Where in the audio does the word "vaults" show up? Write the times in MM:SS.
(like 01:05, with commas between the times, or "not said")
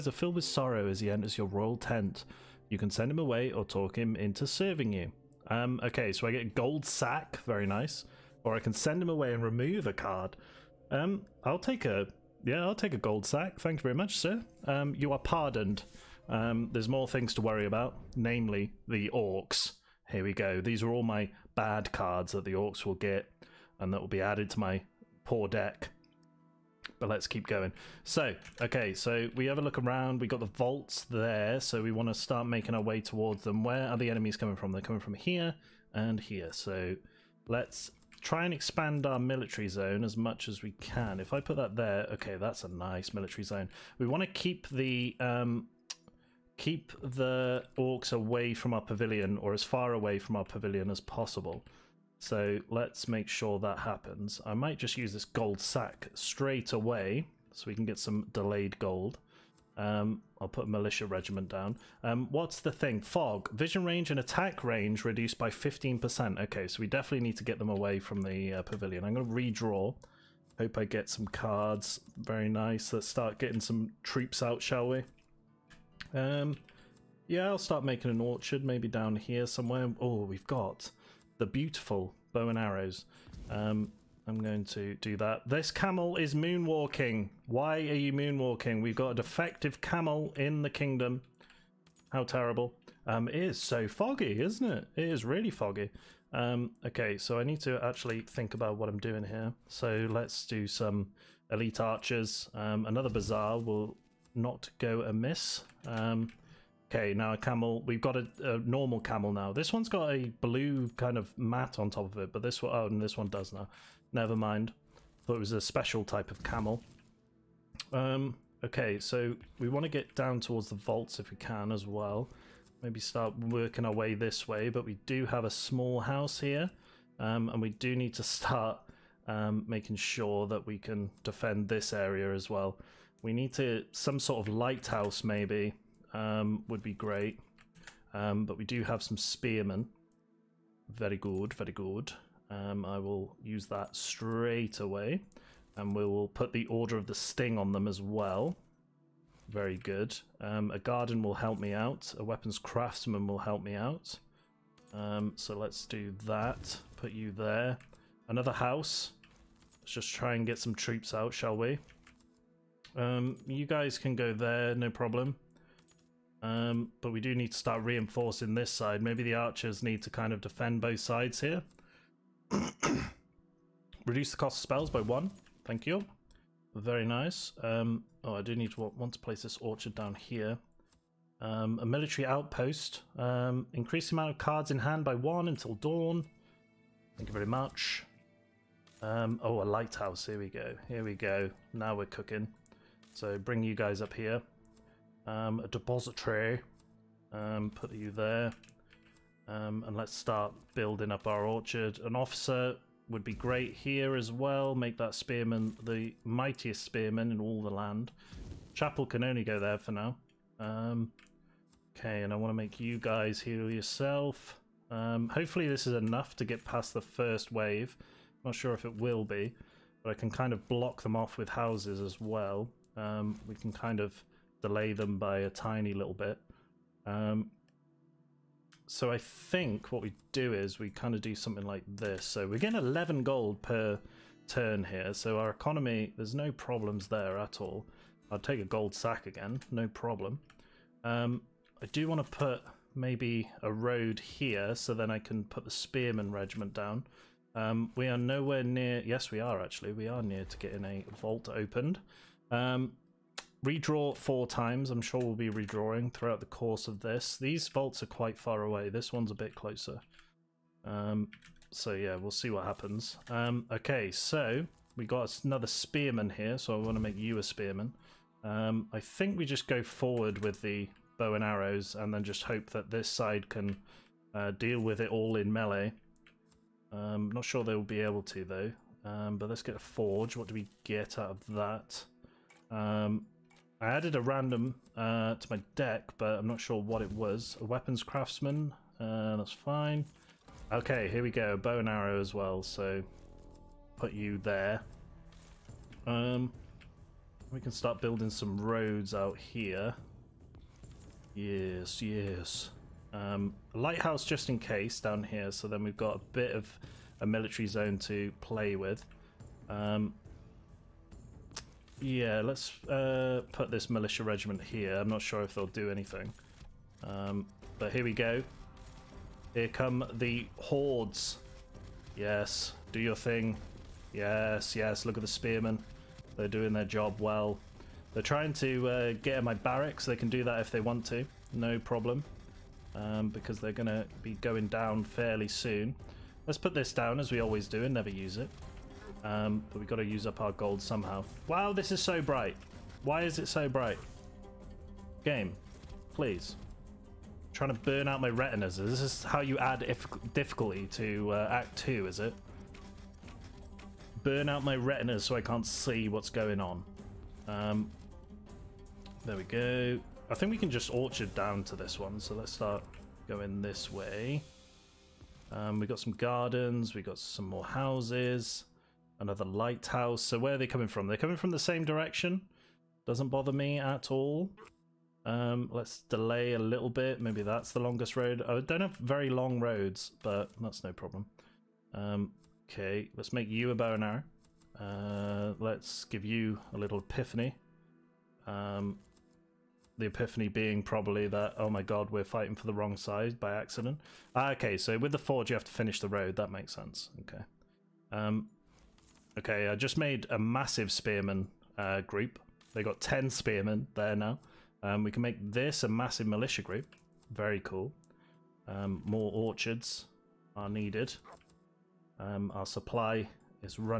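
00:30, 02:00, 04:11, 04:17.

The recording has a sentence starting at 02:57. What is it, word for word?
Um, oh, I do need to want, to place this orchard down here.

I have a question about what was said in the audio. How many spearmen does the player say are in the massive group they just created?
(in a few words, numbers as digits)
10.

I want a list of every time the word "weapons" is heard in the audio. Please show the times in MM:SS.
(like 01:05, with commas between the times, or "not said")
02:32, 04:47.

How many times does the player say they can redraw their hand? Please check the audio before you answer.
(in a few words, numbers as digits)
4.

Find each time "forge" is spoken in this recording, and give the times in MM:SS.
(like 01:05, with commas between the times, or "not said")
04:39, 06:35.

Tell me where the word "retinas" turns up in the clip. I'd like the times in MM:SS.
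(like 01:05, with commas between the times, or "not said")
05:48, 05:54.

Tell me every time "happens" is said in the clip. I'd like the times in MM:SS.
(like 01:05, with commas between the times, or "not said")
00:53, 04:22.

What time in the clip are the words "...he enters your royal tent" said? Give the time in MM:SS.
00:01.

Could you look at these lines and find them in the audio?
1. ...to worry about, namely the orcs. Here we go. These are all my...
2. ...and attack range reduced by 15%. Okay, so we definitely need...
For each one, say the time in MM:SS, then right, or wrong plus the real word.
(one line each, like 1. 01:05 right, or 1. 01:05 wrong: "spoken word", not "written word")
1. 00:17 right
2. 01:04 right.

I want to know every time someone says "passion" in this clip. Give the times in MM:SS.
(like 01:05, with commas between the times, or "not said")
not said.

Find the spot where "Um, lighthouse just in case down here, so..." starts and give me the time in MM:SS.
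05:03.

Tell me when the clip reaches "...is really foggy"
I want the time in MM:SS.
01:35.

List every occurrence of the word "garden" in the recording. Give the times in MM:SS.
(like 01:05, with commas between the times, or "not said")
02:30, 06:06.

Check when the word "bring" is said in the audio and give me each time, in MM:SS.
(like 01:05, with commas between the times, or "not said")
03:13.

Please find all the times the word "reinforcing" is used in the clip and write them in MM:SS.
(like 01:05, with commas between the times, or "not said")
02:47.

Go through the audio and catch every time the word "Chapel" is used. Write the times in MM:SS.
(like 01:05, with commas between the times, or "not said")
03:28.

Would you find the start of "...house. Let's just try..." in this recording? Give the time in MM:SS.
02:38.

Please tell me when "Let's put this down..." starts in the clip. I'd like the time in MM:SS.
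05:36.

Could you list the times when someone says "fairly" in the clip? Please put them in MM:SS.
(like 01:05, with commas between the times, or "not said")
05:35.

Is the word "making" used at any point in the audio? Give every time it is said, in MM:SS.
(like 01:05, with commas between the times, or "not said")
00:32, 01:17, 02:09.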